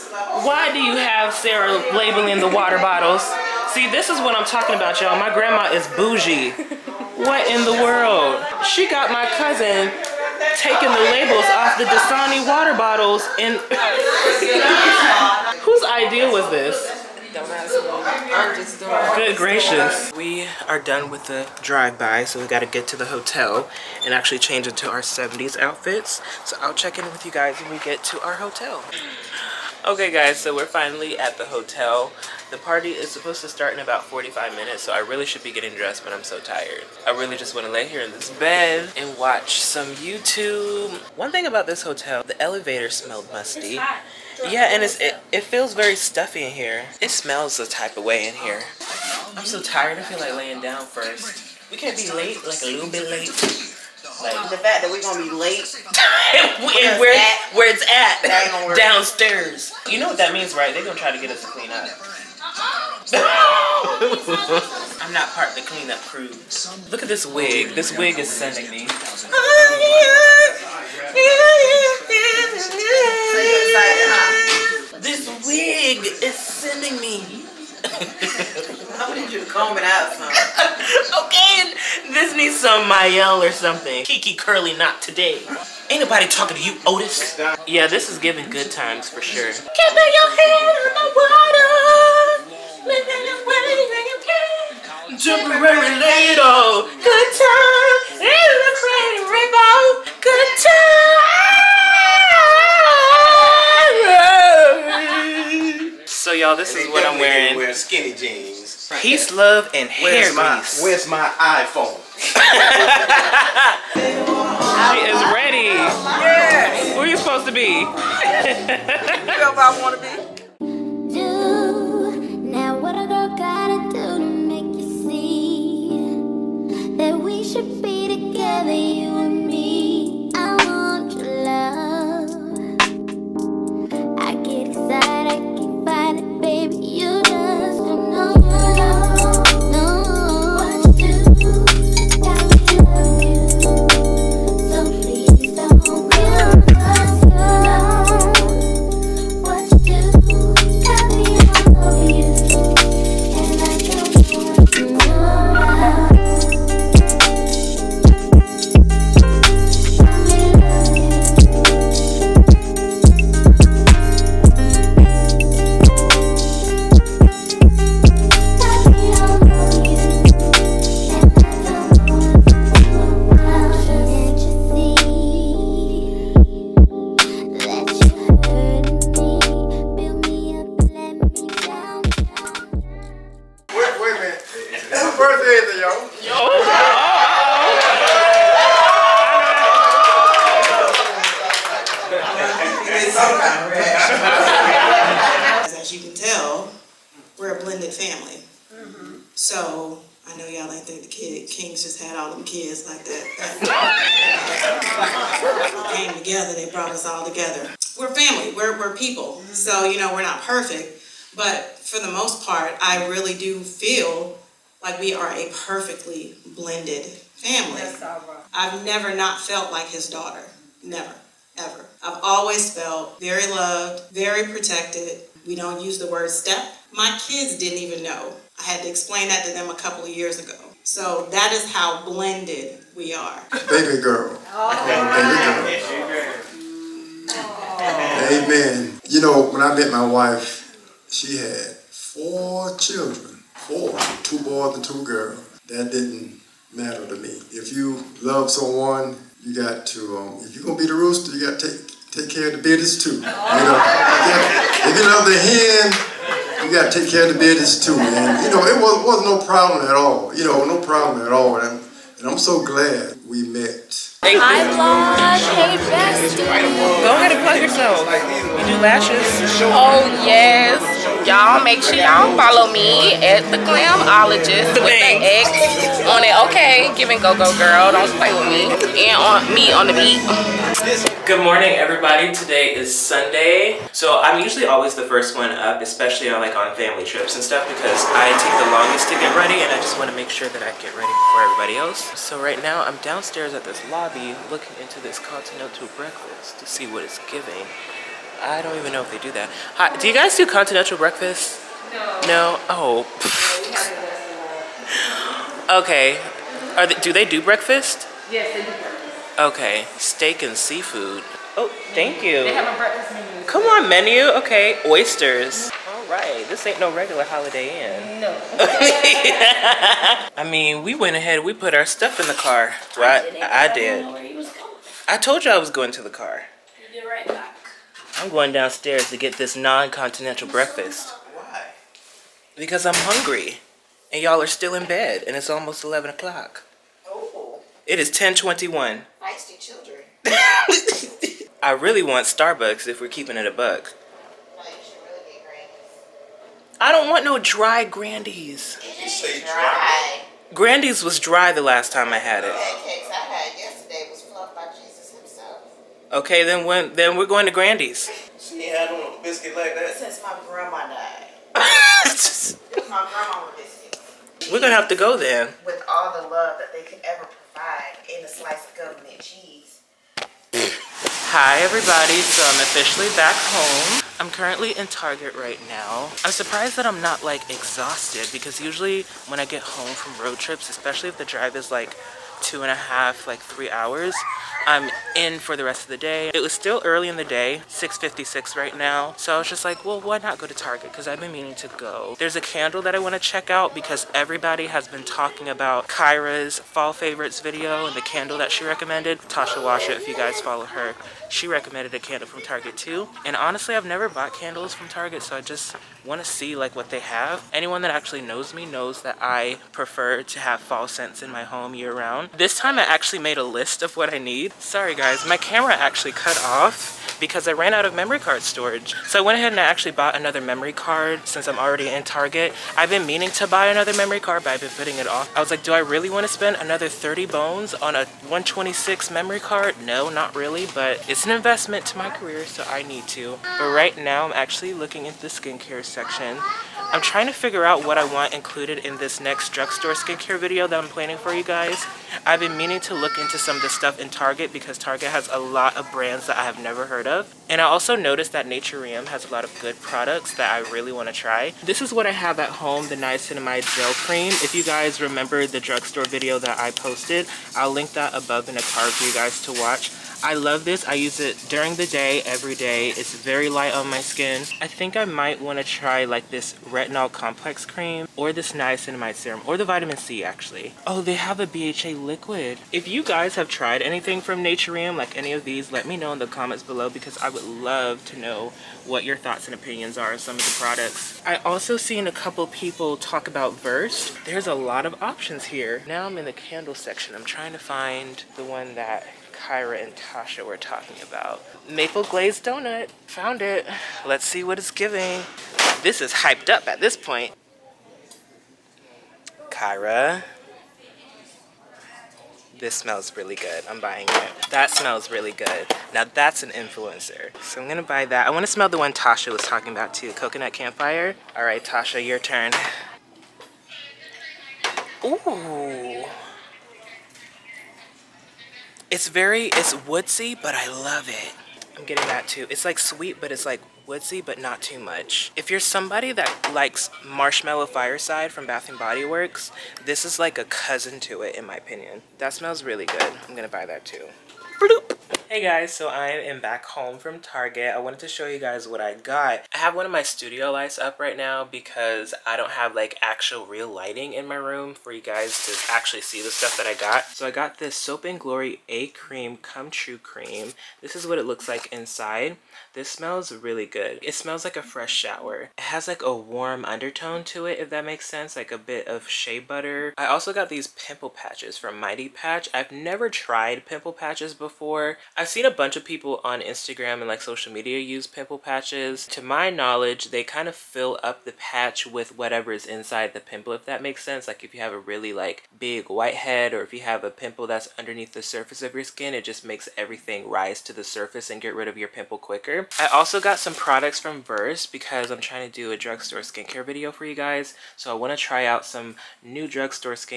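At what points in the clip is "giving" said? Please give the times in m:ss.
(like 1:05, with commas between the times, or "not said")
1:28, 4:57, 8:14.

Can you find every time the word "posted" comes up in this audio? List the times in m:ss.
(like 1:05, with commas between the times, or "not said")
7:36.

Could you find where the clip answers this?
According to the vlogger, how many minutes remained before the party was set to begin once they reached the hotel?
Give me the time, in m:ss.
0:34.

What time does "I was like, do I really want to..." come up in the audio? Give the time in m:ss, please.
7:05.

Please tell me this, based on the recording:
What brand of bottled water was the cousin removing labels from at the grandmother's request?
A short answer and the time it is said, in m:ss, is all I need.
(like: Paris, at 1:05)
Dasani, at 0:11.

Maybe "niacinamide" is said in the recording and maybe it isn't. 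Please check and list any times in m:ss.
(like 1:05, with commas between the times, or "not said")
7:32, 7:48.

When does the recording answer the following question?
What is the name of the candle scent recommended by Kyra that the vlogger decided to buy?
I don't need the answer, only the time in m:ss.
8:11.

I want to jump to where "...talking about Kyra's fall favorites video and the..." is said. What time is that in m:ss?
6:35.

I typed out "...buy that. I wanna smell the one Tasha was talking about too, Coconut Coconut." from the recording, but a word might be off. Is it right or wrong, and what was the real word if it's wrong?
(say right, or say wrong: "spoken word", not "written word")
wrong: "Campfire", not "Coconut".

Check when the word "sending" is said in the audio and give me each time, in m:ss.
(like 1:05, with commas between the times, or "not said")
1:08, 1:16.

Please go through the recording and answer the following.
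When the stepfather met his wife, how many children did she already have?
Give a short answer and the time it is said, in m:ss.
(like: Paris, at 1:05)
4, at 4:01.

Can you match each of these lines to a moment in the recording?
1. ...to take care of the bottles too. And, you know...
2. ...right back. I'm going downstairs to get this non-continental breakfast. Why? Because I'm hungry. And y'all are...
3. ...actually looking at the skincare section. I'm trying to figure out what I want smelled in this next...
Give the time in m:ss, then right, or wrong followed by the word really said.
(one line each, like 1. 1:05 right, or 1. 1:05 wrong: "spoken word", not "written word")
1. 4:16 wrong: "biddies", not "bottles"
2. 5:27 right
3. 7:14 wrong: "included", not "smelled".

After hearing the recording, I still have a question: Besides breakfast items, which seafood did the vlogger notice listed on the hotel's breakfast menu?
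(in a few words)
Oysters.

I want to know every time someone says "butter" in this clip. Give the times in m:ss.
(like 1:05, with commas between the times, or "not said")
9:19.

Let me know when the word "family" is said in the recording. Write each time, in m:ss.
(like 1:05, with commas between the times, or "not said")
3:17, 3:28, 3:37, 4:46.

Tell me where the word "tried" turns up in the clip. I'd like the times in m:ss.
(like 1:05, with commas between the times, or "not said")
7:53, 9:23.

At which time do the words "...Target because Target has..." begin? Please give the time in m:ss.
7:24.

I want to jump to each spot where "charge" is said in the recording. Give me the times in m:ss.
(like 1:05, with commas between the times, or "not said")
not said.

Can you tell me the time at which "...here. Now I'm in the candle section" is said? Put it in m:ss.
8:05.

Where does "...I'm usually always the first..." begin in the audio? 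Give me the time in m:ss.
4:44.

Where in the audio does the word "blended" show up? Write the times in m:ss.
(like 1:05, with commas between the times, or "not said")
3:17, 3:36, 3:52.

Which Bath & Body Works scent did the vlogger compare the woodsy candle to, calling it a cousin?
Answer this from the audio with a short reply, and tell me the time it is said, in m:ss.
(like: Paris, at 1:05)
Marshmallow Fireside, at 8:47.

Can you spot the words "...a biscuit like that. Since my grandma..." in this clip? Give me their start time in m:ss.
5:59.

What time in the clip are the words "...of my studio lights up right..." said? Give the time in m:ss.
8:59.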